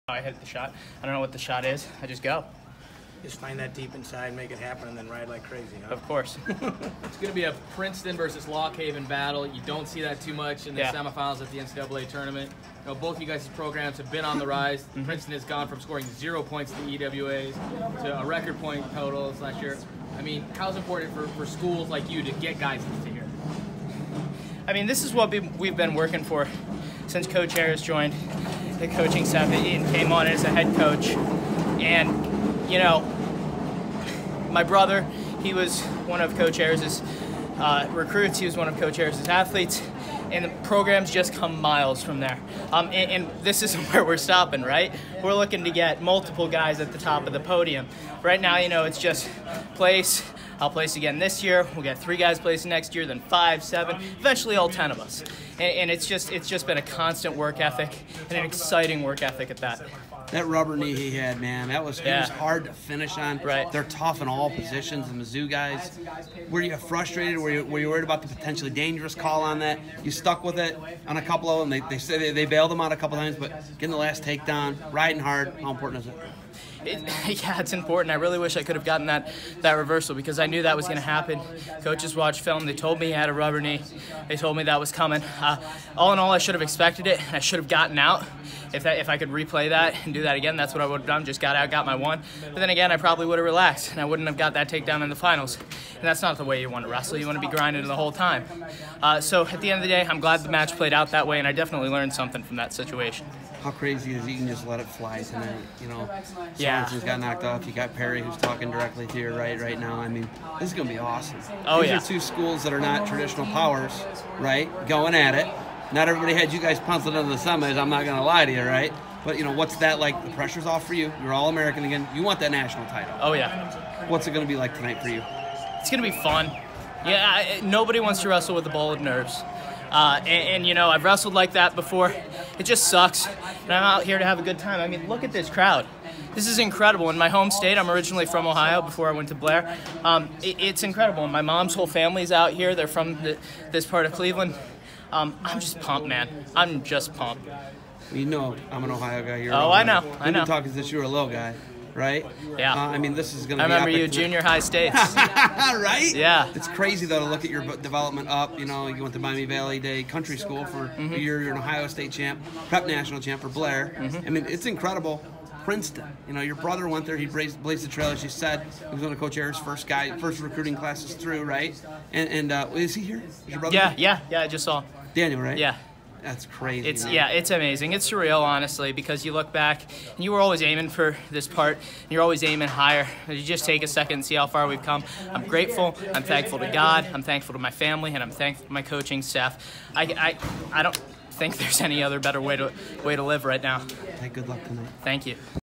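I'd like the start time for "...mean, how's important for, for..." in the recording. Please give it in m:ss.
0:20.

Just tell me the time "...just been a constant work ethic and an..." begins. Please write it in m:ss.
0:56.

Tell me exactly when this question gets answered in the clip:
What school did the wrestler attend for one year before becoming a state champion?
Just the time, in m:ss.
2:39.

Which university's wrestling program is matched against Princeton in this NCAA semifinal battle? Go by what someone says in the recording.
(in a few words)
Lock Haven.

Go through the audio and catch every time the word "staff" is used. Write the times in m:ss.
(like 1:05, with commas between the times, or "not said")
0:29, 3:09.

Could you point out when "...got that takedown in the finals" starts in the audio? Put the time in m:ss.
1:34.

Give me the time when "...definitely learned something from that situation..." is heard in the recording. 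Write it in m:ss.
1:41.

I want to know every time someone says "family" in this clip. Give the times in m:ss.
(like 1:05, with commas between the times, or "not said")
2:21, 3:07.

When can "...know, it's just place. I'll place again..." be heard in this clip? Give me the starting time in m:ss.
0:48.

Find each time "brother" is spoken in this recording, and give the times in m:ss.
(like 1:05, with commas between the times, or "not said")
0:34, 2:46, 2:53.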